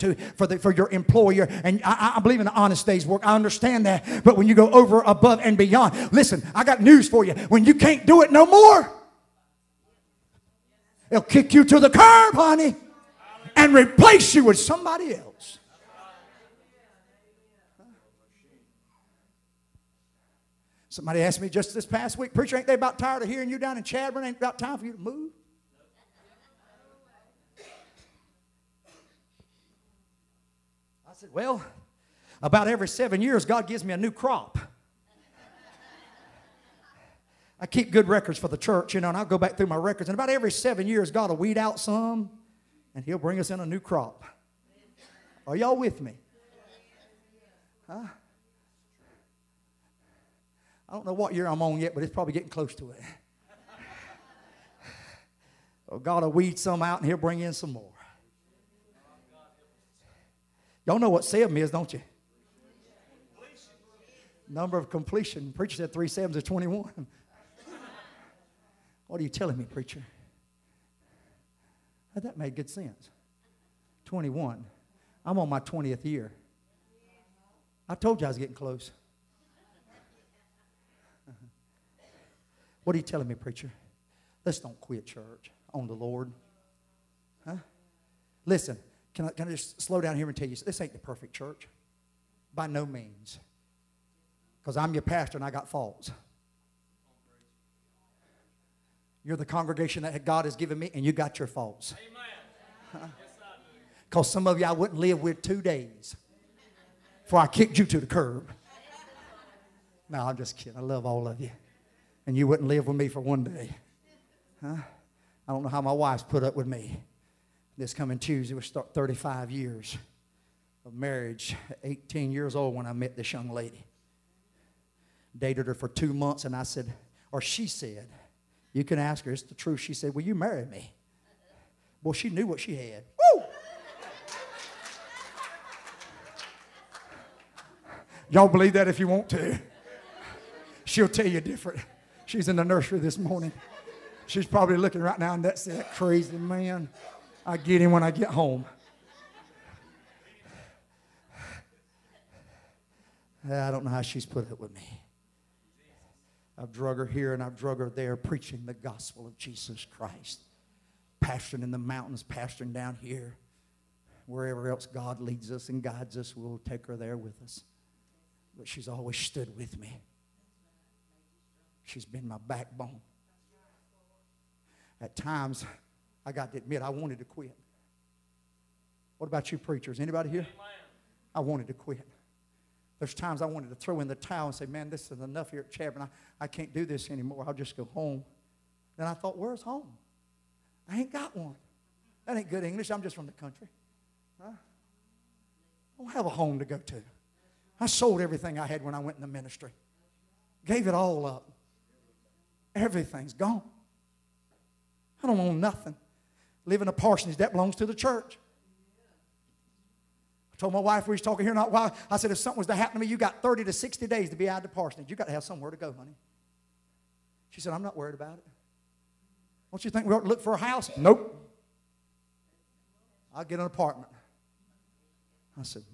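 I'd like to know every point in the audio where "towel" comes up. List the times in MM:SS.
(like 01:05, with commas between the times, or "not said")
03:04.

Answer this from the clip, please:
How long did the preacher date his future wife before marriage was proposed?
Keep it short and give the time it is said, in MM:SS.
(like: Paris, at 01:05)
two months, at 02:05.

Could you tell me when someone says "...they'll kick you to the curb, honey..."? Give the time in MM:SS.
00:11.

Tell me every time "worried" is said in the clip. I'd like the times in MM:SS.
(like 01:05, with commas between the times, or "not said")
03:37.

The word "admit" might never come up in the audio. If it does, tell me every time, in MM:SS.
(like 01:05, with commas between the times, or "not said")
02:56.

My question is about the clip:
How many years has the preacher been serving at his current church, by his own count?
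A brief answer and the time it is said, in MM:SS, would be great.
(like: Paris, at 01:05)
20th year, at 01:15.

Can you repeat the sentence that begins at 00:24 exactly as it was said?
Ain't about time for you to move?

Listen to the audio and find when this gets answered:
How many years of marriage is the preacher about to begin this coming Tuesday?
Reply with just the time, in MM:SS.
01:58.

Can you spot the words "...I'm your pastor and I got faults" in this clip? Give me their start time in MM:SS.
01:34.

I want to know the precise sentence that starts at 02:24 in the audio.
She's probably looking right now and that's that crazy man.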